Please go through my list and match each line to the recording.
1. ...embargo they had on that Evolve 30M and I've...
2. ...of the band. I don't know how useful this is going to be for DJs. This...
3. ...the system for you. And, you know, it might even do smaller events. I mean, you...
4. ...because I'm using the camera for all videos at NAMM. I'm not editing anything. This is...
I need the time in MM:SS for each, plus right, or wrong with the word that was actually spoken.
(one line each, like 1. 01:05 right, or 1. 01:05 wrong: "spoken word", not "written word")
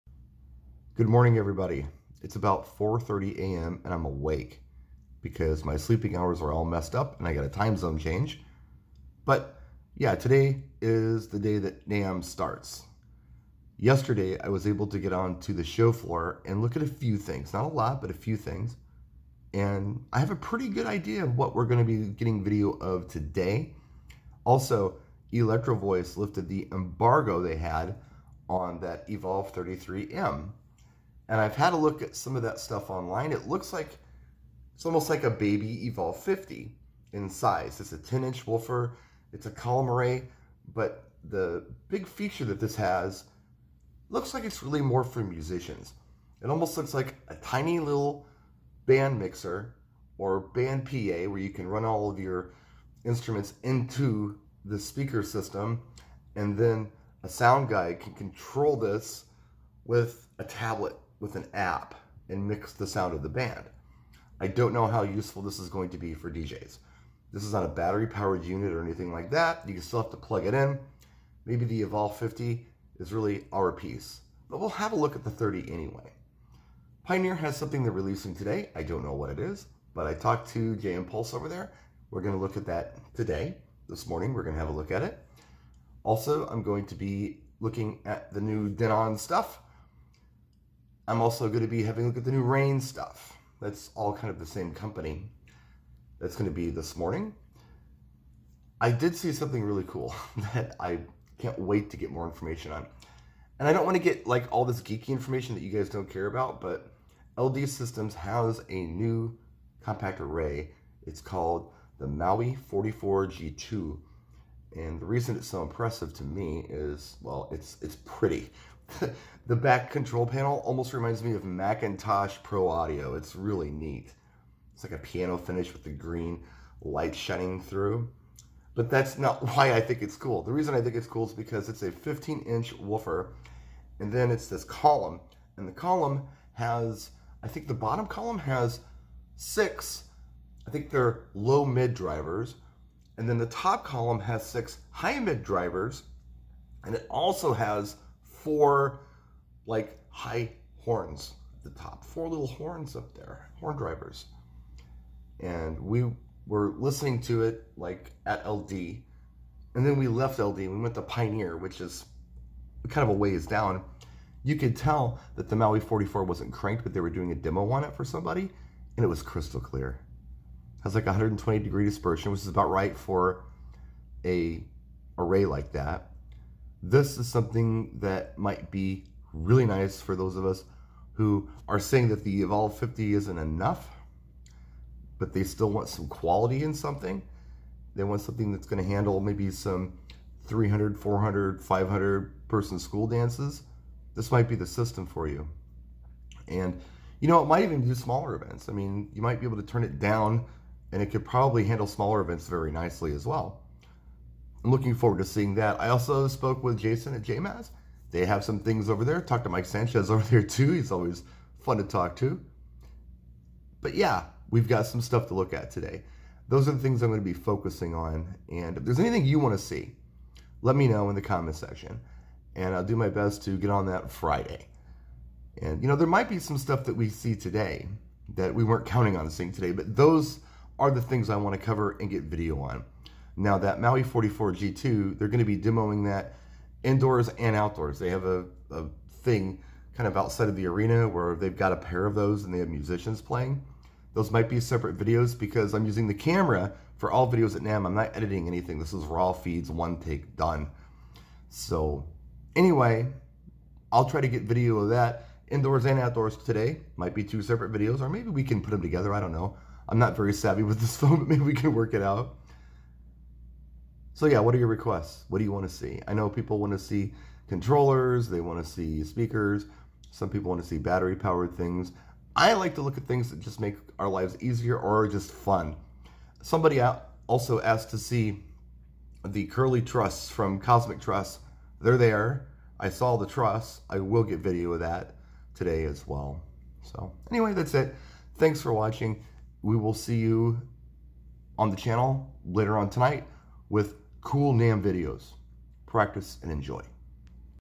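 1. 00:26 right
2. 01:03 right
3. 03:14 right
4. 04:05 right.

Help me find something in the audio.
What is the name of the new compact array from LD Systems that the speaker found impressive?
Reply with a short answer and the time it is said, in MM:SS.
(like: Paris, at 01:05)
Maui 44G2, at 01:52.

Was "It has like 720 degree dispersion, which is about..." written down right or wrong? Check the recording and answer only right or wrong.
wrong.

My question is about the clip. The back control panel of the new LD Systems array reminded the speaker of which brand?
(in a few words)
McIntosh.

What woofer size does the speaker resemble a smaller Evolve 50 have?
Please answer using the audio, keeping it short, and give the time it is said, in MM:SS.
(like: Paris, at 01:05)
10 inch, at 00:37.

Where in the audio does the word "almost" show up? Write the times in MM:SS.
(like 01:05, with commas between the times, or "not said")
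00:34, 00:46, 02:00.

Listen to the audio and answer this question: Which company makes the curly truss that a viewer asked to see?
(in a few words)
Cosmic Truss.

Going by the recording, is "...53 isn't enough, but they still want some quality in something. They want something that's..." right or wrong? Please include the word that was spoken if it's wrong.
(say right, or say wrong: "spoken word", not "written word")
wrong: "50", not "53".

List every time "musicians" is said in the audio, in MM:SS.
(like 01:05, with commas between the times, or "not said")
00:45, 04:02.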